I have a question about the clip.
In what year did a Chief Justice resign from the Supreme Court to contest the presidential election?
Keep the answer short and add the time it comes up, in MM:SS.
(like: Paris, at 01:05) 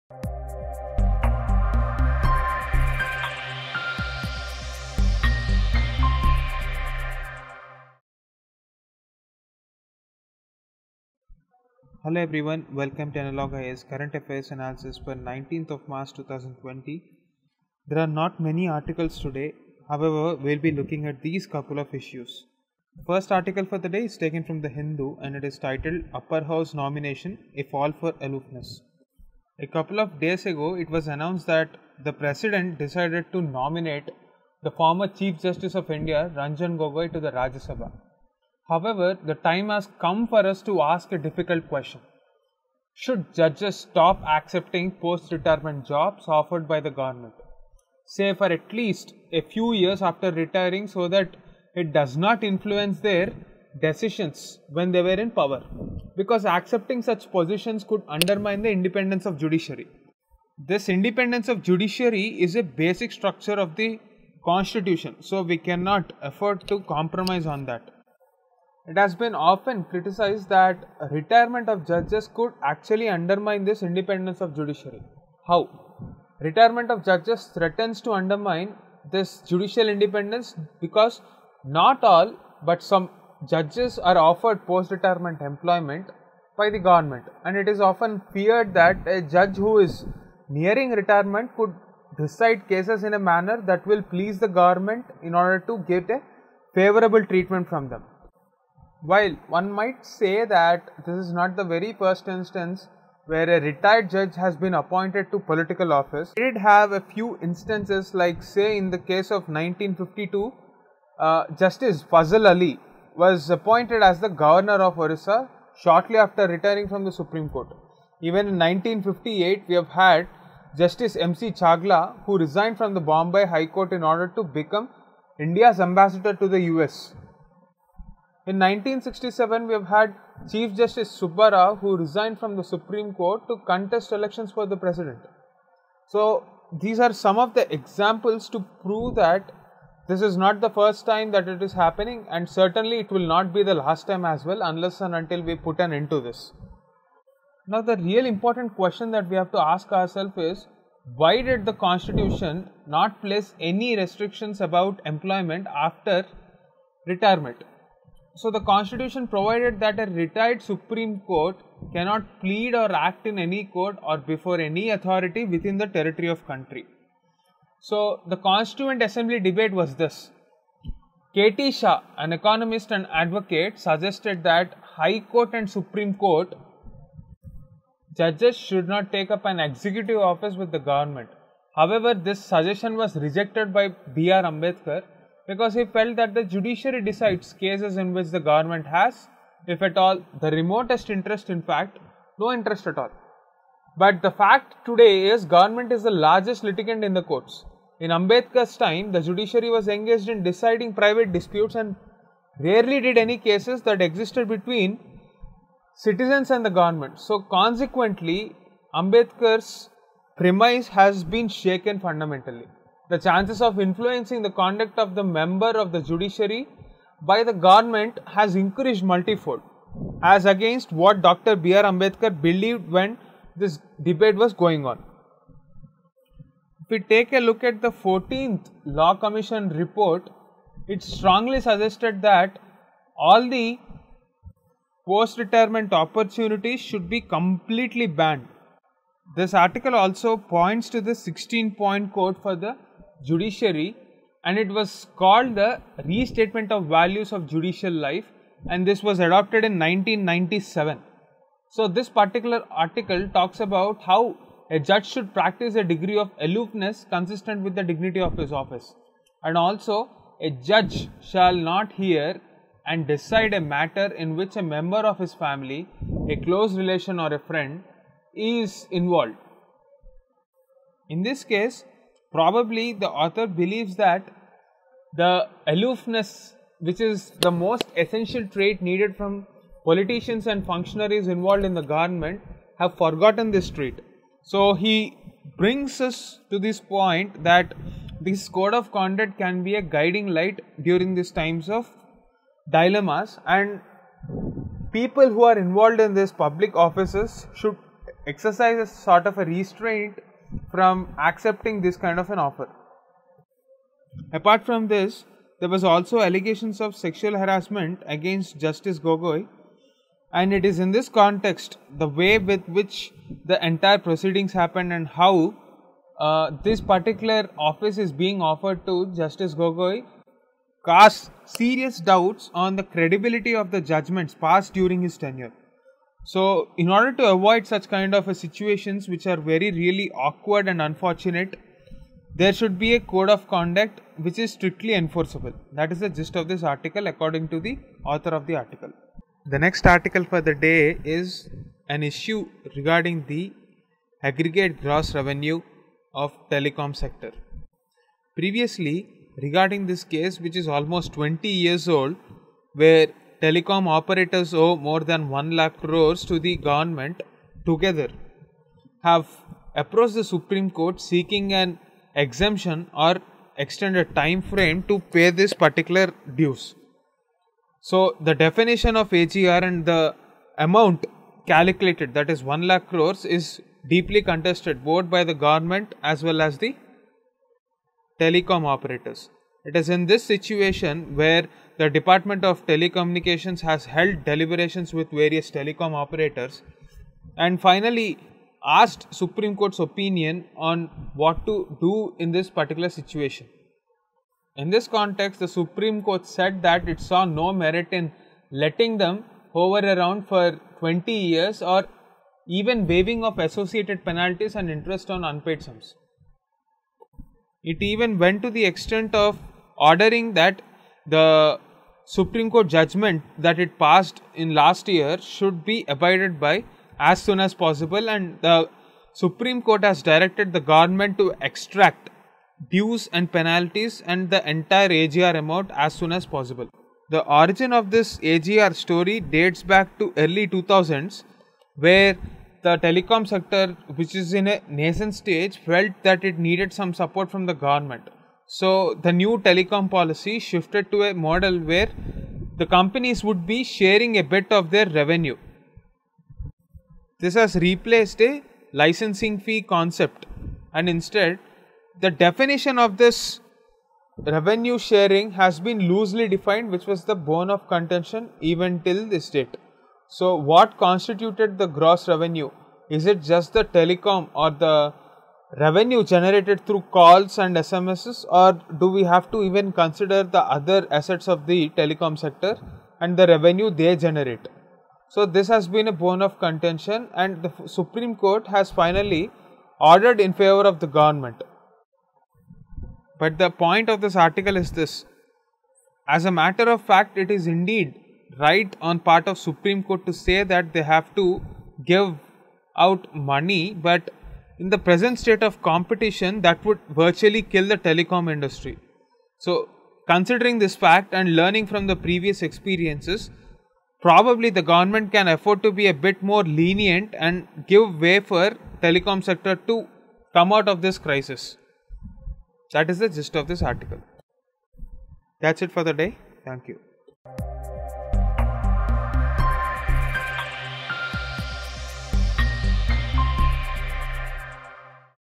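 1967, at 02:08.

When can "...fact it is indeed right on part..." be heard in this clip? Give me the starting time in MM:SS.
08:06.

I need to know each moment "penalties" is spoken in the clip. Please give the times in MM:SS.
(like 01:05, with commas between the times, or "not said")
06:44, 07:03.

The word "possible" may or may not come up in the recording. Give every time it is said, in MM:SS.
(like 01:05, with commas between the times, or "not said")
06:57, 07:06.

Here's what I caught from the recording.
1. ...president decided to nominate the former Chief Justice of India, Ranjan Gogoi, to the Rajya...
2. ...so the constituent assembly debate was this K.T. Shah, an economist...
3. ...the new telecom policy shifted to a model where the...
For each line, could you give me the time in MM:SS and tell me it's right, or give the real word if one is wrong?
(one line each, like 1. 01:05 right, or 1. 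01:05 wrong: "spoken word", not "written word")
1. 00:32 right
2. 02:47 right
3. 07:19 right.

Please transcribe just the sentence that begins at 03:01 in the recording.
However, this suggestion was rejected by B.R.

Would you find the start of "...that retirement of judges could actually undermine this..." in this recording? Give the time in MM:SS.
01:10.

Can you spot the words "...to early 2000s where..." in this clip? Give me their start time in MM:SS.
07:09.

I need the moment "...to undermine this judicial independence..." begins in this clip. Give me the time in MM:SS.
01:18.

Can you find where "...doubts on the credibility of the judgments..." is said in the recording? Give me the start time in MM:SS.
05:21.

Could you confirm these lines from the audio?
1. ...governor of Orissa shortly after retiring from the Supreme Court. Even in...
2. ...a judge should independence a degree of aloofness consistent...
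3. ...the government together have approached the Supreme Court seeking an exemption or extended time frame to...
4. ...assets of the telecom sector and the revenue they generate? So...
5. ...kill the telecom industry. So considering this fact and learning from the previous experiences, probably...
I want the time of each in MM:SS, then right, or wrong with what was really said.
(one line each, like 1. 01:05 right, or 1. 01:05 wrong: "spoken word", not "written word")
1. 01:54 right
2. 04:14 wrong: "practice", not "independence"
3. 05:56 right
4. 07:50 right
5. 08:17 right.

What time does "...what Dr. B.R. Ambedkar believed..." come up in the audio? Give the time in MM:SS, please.
03:41.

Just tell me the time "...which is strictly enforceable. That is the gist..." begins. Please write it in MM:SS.
05:34.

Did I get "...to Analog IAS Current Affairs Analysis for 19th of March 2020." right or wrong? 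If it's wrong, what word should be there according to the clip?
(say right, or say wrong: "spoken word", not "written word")
right.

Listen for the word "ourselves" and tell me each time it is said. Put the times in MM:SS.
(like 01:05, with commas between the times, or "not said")
02:29.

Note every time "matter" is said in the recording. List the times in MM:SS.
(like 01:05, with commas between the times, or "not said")
04:23, 08:06.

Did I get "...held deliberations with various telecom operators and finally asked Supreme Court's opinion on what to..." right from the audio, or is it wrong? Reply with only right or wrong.
right.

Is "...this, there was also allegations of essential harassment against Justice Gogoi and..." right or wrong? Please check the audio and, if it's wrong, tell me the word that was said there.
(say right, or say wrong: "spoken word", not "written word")
wrong: "sexual", not "essential".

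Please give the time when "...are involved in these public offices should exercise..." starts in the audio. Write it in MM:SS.
04:55.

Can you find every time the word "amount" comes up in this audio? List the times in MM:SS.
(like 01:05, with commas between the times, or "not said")
06:10, 07:05.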